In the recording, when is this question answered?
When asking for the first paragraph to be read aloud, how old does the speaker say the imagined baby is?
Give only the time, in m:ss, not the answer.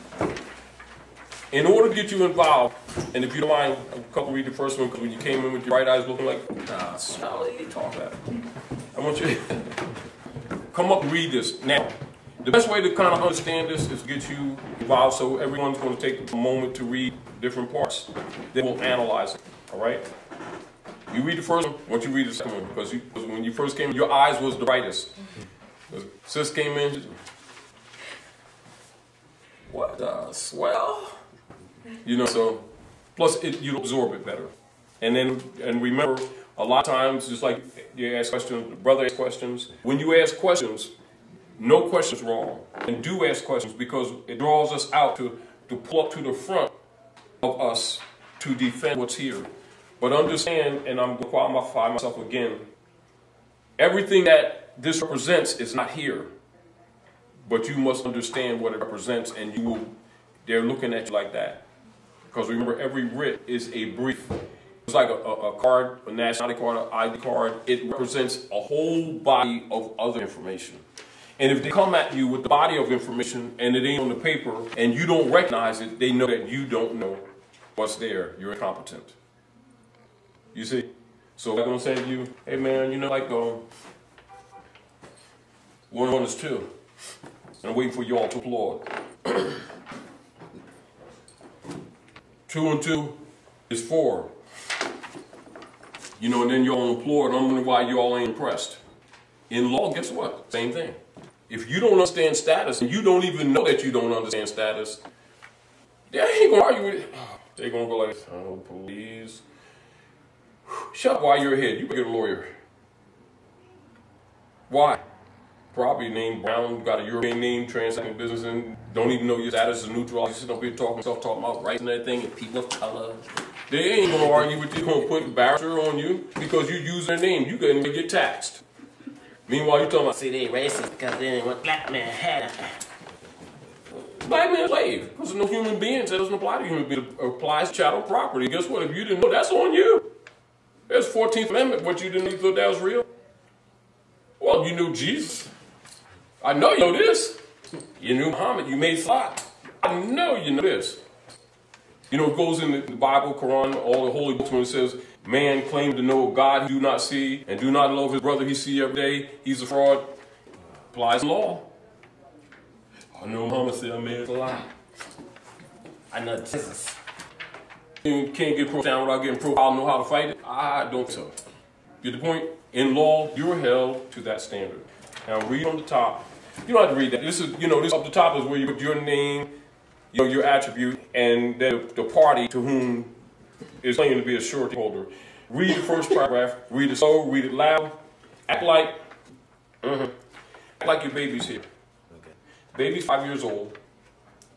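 3:13.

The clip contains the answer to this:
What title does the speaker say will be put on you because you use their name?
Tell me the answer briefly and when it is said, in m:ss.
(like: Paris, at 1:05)
barrister, at 2:05.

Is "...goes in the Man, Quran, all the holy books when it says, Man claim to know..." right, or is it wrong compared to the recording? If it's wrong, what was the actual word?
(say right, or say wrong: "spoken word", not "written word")
wrong: "Bible", not "Man".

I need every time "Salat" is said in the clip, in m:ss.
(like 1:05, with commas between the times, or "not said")
2:28.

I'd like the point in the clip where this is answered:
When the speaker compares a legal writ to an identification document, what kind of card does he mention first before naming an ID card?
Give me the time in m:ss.
1:06.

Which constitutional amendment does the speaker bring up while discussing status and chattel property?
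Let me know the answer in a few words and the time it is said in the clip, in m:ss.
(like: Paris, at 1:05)
14th Amendment, at 2:21.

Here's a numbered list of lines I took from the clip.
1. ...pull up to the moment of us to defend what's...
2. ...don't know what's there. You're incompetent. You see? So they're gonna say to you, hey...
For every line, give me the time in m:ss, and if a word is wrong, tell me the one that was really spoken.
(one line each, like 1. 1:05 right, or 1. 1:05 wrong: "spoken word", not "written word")
1. 0:45 wrong: "front", not "moment"
2. 1:16 right.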